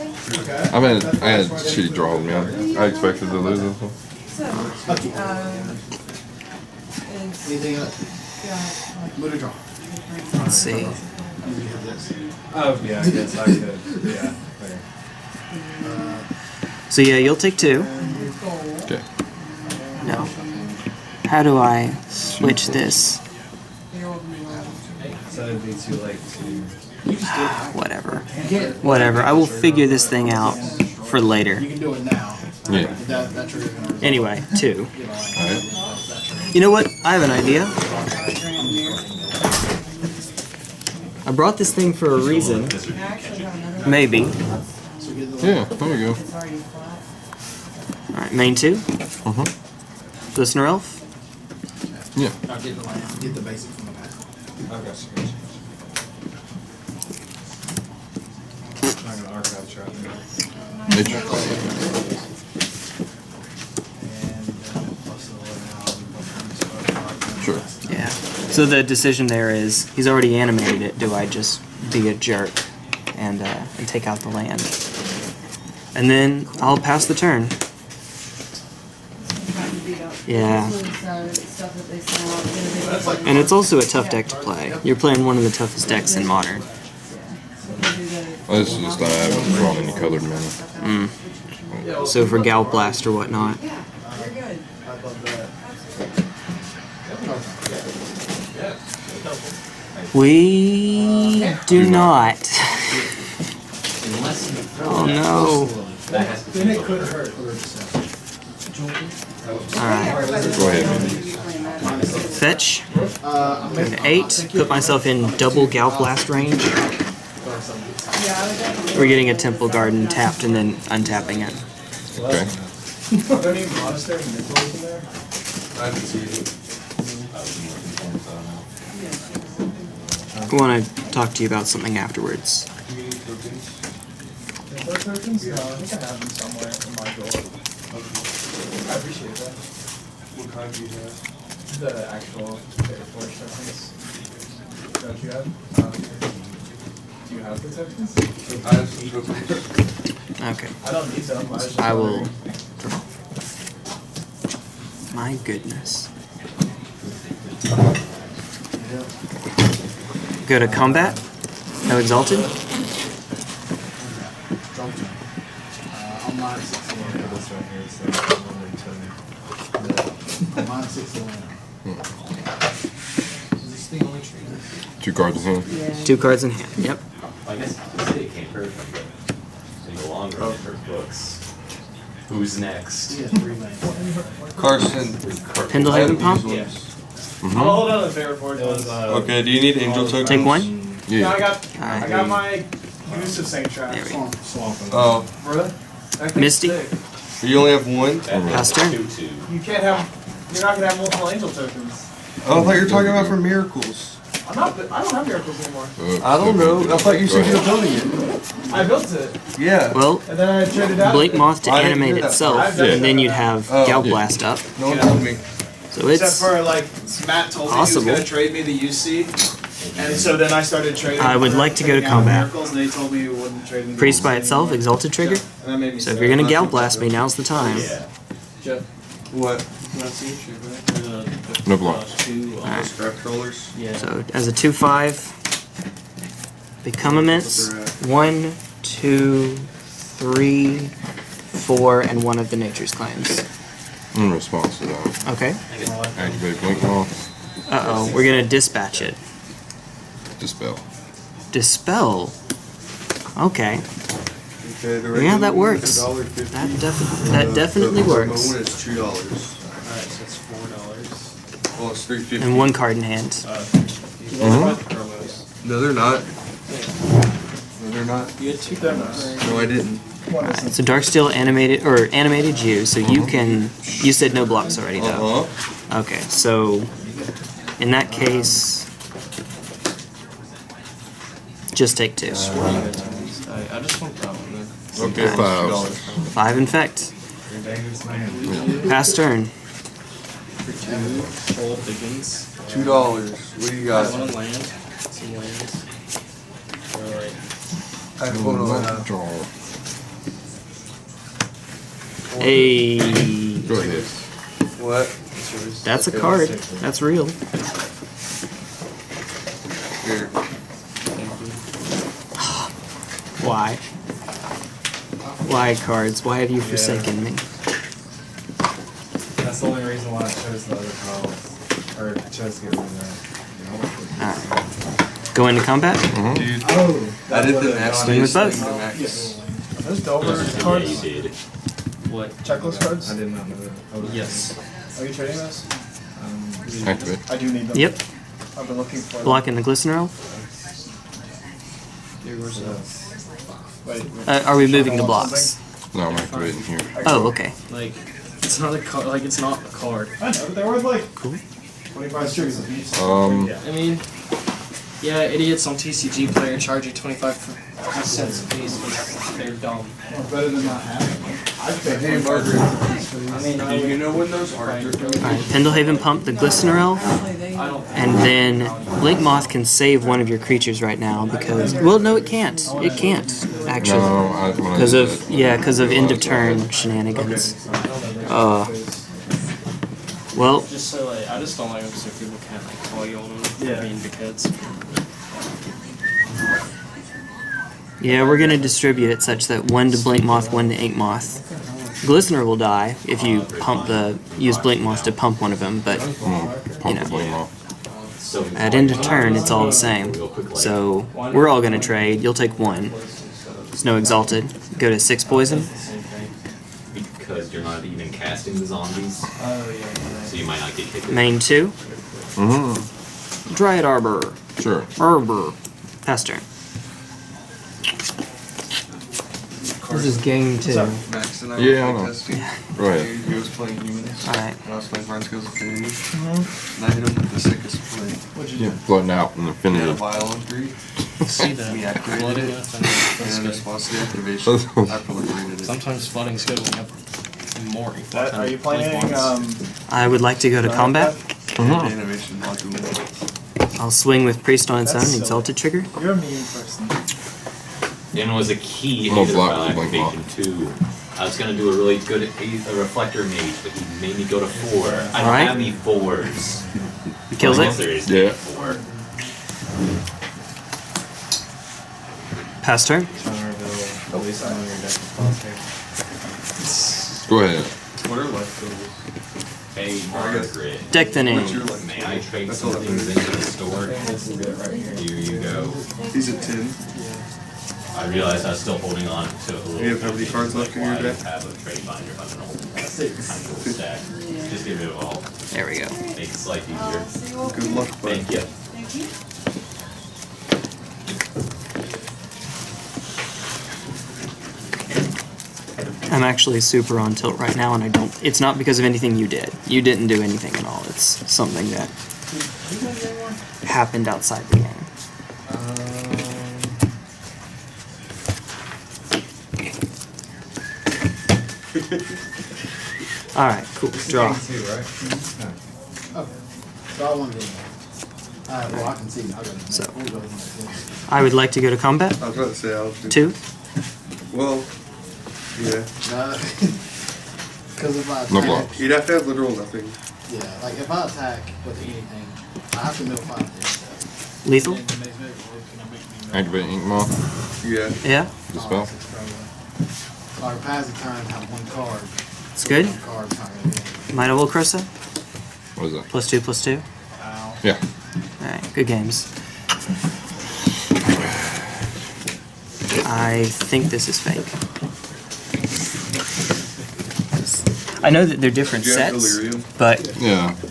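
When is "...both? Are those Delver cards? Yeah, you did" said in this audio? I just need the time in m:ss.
5:28.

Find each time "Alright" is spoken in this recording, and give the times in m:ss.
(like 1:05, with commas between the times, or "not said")
0:48, 1:49, 4:19, 5:24, 7:04, 7:35.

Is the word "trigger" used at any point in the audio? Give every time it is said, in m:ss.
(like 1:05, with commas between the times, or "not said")
3:45, 7:25.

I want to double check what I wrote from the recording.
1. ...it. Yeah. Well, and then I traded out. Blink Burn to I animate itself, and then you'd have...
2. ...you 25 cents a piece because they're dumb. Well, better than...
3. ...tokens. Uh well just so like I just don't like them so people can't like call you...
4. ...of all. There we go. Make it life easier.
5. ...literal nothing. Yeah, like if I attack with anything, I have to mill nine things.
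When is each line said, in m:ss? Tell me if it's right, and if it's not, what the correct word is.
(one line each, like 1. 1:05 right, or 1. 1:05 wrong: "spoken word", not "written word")
1. 3:29 wrong: "Moth", not "Burn"
2. 5:56 right
3. 6:16 wrong: "shenanigans", not "tokens"
4. 8:04 right
5. 8:49 wrong: "five", not "nine".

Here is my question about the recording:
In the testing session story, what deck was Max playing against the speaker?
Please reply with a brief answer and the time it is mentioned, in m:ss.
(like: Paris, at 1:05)
Humans, at 7:03.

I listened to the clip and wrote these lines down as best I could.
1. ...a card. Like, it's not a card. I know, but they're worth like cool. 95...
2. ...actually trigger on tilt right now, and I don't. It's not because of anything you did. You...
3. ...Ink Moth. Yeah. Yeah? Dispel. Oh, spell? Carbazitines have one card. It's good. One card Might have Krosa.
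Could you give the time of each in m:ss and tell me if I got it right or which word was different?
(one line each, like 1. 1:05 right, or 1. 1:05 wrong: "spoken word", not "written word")
1. 5:48 wrong: "25", not "95"
2. 8:16 wrong: "super", not "trigger"
3. 8:56 right.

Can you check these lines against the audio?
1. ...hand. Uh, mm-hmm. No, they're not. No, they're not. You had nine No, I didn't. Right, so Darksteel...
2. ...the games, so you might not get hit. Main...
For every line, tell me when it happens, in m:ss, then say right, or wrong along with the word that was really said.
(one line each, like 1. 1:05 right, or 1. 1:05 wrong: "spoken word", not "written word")
1. 4:23 wrong: "two", not "nine"
2. 6:48 wrong: "zombies", not "games".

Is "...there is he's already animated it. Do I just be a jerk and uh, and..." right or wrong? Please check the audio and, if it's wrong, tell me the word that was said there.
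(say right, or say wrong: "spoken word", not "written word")
right.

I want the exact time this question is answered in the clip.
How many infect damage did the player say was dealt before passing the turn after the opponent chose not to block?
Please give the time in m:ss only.
4:46.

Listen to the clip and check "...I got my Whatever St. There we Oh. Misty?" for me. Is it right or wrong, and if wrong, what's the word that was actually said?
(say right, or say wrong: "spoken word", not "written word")
wrong: "Goose", not "Whatever".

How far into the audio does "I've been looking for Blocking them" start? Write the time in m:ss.
5:38.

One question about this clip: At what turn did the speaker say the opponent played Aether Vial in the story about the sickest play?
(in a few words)
3.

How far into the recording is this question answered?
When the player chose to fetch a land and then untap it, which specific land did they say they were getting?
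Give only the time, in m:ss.
1:59.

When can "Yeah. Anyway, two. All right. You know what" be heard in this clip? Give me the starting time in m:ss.
0:32.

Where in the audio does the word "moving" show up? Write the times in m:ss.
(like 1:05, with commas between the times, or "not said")
5:44.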